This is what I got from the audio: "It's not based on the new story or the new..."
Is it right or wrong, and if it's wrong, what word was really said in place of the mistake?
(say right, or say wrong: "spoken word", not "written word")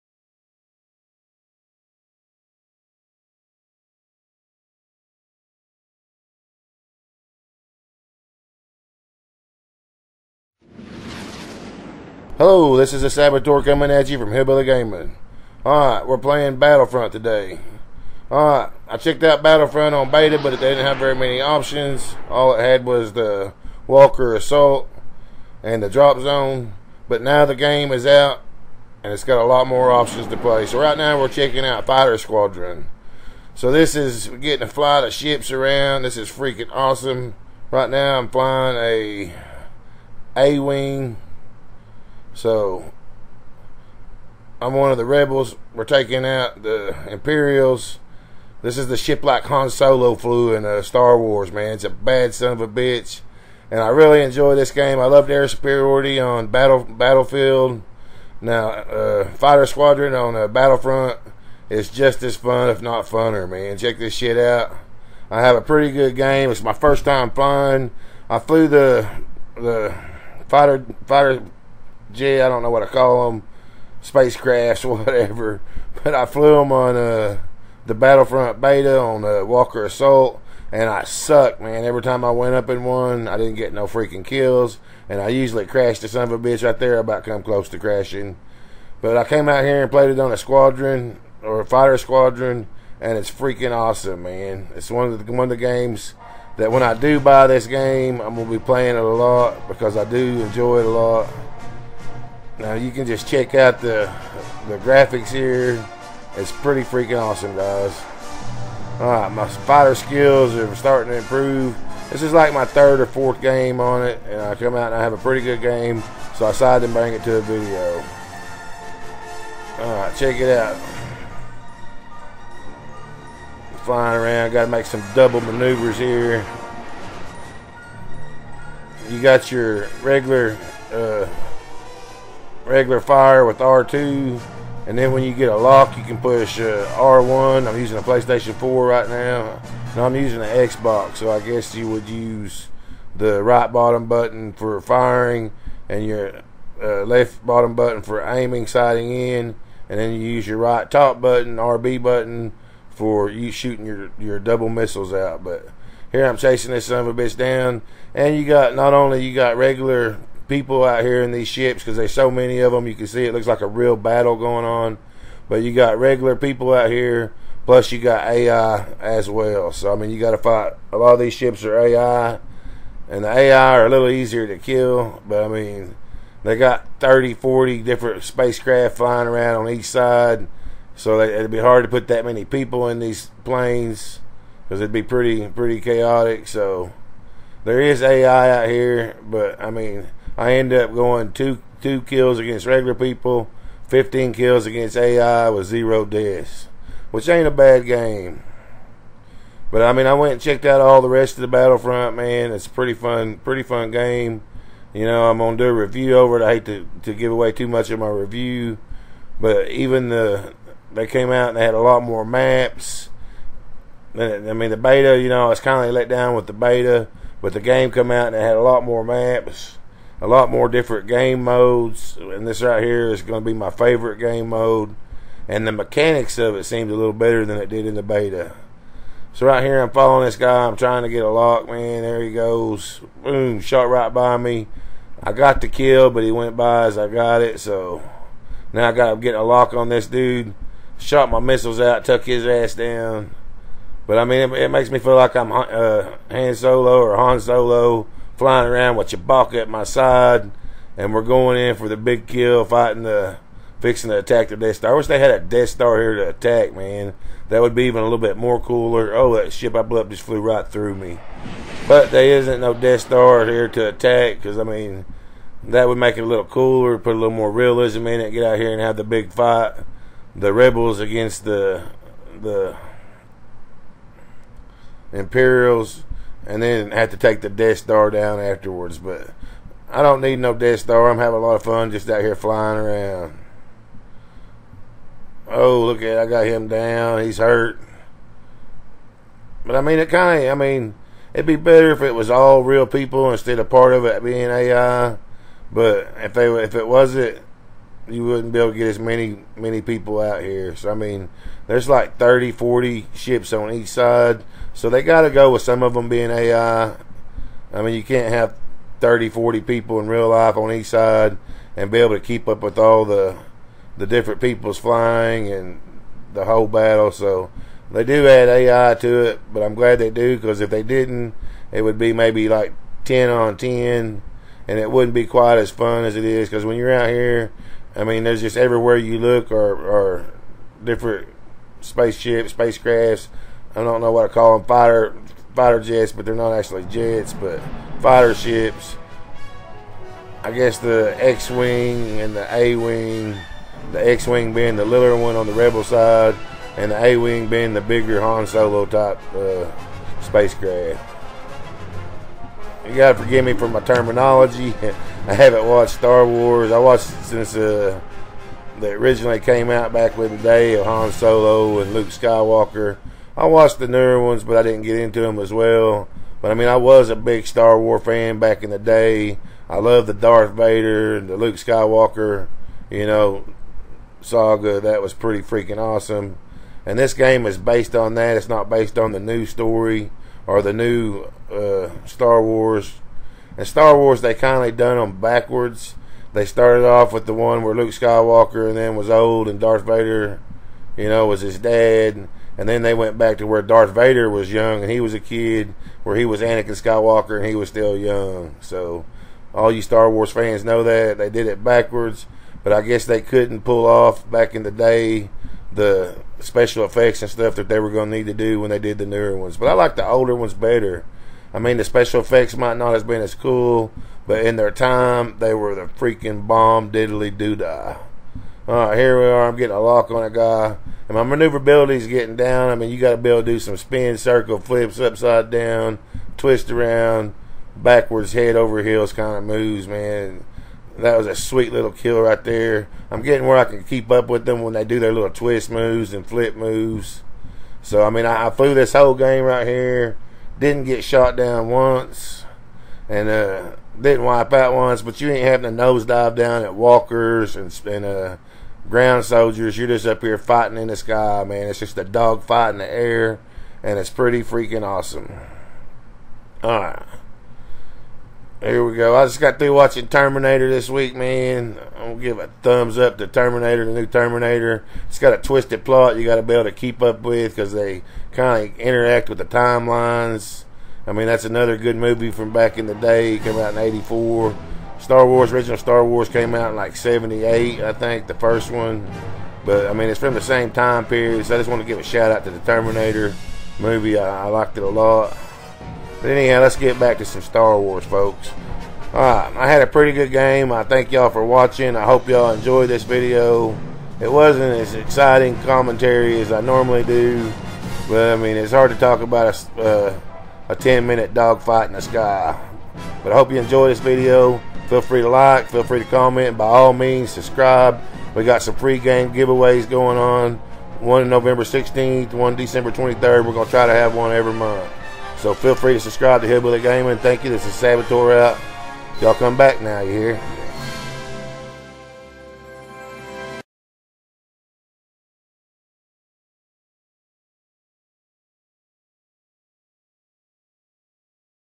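right.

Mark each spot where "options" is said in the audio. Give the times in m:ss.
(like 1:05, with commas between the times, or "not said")
0:21, 0:29.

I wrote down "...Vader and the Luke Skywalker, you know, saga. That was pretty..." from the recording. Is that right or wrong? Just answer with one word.
right.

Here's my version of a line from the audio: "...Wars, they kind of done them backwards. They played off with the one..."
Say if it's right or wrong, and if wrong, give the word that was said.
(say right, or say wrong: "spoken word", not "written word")
wrong: "started", not "played".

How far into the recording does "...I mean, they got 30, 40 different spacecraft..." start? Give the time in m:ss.
2:55.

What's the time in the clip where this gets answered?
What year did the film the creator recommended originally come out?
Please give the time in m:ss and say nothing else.
7:53.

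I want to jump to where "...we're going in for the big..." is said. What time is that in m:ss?
4:11.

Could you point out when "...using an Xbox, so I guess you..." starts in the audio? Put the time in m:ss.
2:20.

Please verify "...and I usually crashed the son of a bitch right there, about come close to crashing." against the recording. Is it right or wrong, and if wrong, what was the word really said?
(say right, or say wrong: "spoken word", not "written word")
right.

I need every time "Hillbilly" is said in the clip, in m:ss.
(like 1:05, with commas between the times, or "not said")
0:14, 8:36.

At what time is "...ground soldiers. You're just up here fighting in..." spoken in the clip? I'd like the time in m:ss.
7:28.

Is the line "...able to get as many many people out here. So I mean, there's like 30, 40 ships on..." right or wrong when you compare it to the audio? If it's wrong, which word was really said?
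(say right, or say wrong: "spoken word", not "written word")
right.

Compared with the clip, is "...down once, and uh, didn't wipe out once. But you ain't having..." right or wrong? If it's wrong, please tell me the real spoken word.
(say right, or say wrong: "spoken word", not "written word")
right.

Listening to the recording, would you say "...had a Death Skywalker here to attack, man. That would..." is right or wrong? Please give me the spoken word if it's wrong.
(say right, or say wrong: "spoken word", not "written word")
wrong: "Star", not "Skywalker".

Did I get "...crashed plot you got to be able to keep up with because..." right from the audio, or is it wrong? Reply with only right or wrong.
wrong.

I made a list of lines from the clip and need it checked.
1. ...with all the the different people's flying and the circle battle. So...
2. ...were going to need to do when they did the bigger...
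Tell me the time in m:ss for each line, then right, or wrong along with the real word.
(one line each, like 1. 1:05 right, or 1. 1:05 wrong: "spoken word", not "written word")
1. 5:12 wrong: "whole", not "circle"
2. 6:47 wrong: "newer", not "bigger".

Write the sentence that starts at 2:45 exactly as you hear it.
But you got regular people out here, plus you got AI as well.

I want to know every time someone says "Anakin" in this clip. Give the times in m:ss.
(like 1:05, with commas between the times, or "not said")
6:36.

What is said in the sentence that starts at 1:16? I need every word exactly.
But I flew them on uh, the Battlefront Beta on the uh, Walker Assault, and I sucked, man.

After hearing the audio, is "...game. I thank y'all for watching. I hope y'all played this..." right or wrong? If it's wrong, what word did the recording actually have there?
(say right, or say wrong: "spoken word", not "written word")
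wrong: "enjoyed", not "played".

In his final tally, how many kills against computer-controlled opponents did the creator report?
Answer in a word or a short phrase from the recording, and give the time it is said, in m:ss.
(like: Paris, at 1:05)
15, at 3:13.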